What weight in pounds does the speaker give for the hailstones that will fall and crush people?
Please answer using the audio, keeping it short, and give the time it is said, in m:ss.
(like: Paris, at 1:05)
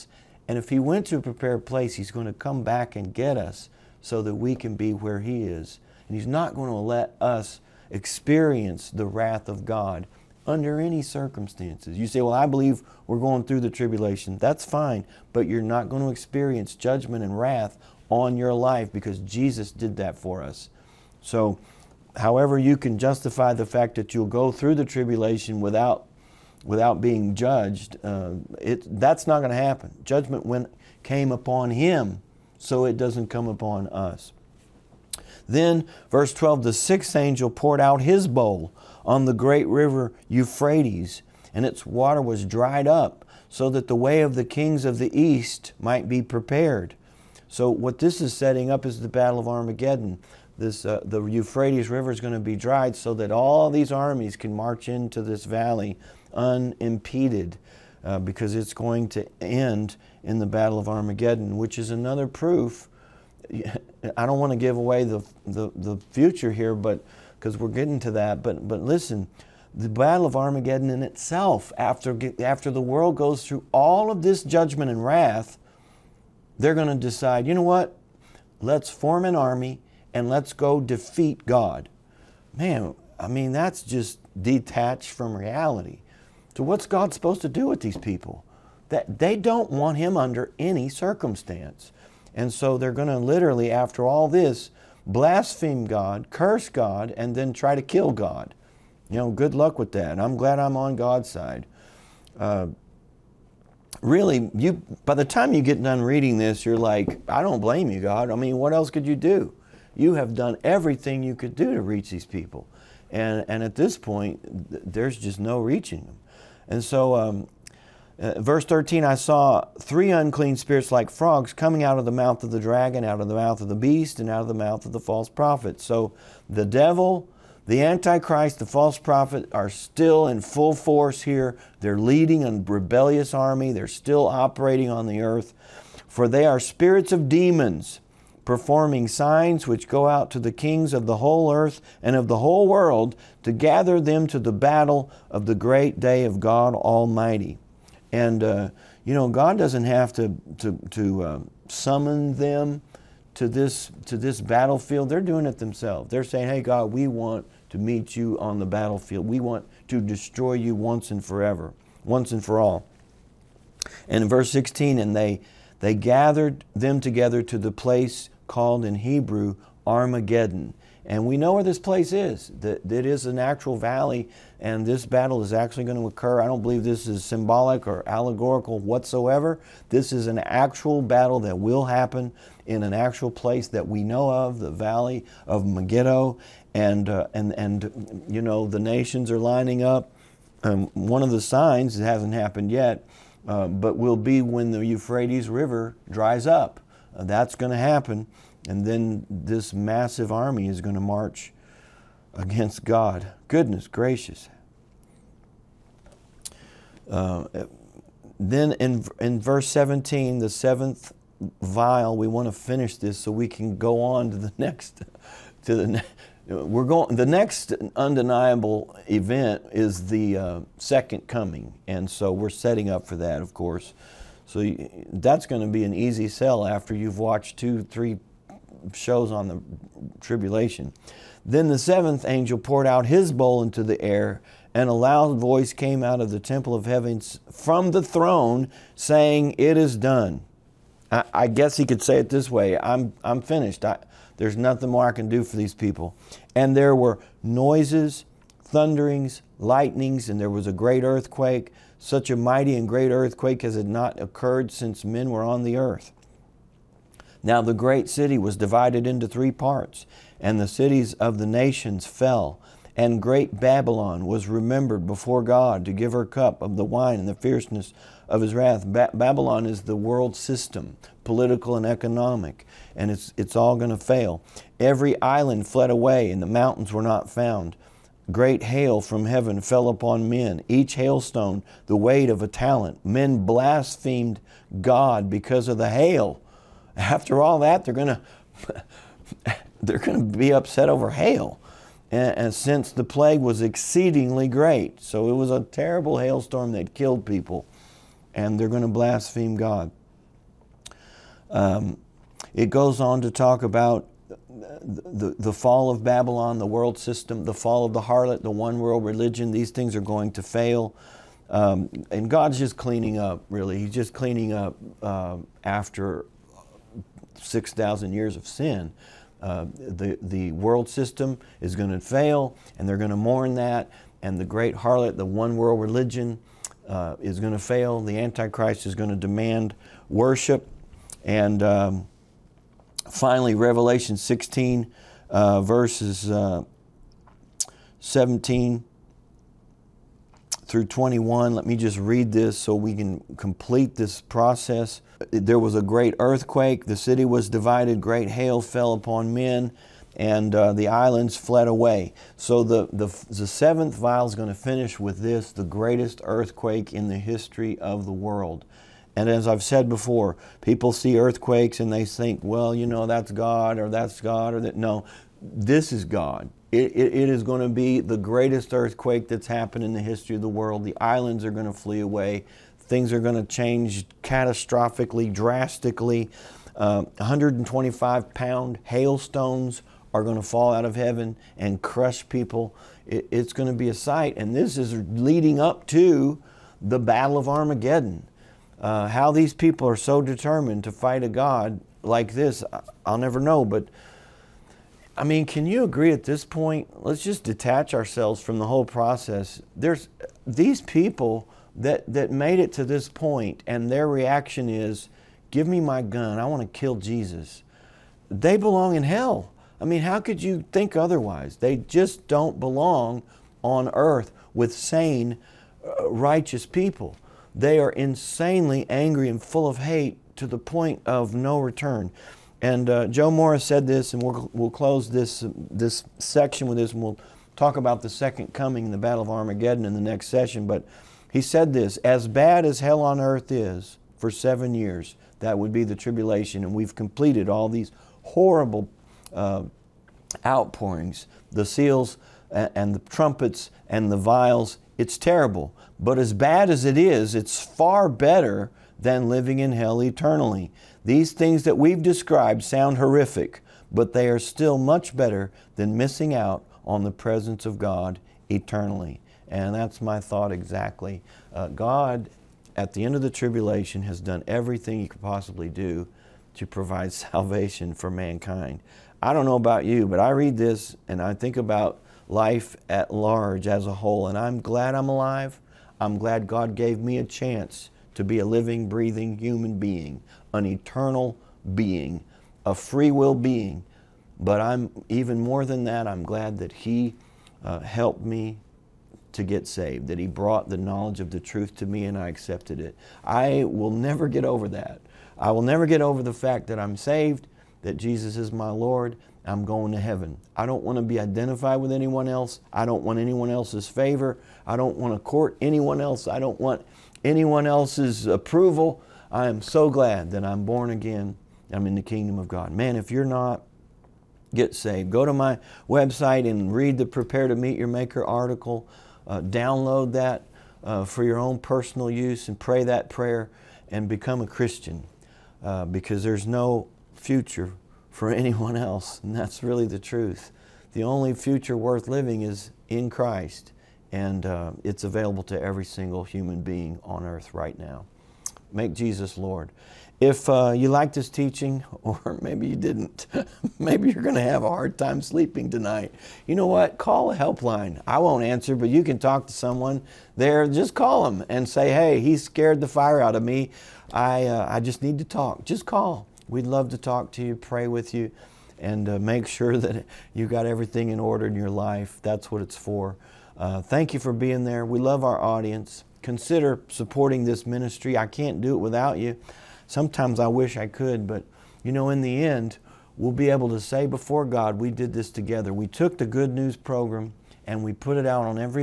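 125, at 6:17.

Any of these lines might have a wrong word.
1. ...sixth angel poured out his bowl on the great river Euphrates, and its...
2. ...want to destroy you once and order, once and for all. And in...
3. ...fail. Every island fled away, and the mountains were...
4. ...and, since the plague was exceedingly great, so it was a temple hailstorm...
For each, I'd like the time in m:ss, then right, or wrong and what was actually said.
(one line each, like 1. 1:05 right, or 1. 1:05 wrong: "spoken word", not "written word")
1. 0:36 right
2. 2:39 wrong: "forever", not "order"
3. 4:33 right
4. 4:52 wrong: "terrible", not "temple".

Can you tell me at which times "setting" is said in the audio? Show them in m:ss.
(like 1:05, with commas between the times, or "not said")
0:48, 3:42.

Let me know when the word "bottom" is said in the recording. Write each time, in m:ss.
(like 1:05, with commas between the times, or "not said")
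not said.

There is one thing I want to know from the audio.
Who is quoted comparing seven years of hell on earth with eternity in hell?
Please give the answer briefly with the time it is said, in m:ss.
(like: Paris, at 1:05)
Joe Morris, at 7:03.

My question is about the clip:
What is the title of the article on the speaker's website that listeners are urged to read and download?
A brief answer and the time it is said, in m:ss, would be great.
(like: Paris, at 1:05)
Prepare to Meet Your Maker, at 8:37.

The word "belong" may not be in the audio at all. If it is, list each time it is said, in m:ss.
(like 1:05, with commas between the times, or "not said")
6:48, 6:52.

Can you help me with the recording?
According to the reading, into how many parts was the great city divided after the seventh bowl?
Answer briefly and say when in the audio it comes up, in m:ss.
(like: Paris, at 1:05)
3, at 4:19.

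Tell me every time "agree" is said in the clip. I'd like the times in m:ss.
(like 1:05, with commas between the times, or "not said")
6:35.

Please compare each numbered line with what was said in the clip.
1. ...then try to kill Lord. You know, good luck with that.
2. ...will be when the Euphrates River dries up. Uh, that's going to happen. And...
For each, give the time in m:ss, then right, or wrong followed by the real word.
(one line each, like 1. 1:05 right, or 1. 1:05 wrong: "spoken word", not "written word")
1. 1:37 wrong: "God", not "Lord"
2. 3:13 right.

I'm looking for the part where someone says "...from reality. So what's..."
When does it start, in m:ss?
1:25.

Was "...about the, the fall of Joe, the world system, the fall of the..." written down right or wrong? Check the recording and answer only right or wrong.
wrong.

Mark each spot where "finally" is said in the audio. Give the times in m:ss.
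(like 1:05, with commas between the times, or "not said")
5:33.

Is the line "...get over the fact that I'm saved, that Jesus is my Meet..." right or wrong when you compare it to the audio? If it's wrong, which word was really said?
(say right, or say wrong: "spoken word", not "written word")
wrong: "Lord", not "Meet".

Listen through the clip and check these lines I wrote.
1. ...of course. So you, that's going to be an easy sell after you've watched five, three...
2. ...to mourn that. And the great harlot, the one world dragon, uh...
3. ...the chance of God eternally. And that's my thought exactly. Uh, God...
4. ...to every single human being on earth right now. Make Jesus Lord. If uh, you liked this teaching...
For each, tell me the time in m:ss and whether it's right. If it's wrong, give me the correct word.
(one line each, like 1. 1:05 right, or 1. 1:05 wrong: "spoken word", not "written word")
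1. 3:43 wrong: "two", not "five"
2. 5:23 wrong: "religion", not "dragon"
3. 7:37 wrong: "presence", not "chance"
4. 8:55 right.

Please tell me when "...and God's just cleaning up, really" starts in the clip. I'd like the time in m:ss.
5:12.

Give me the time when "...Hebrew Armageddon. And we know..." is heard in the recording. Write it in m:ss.
2:48.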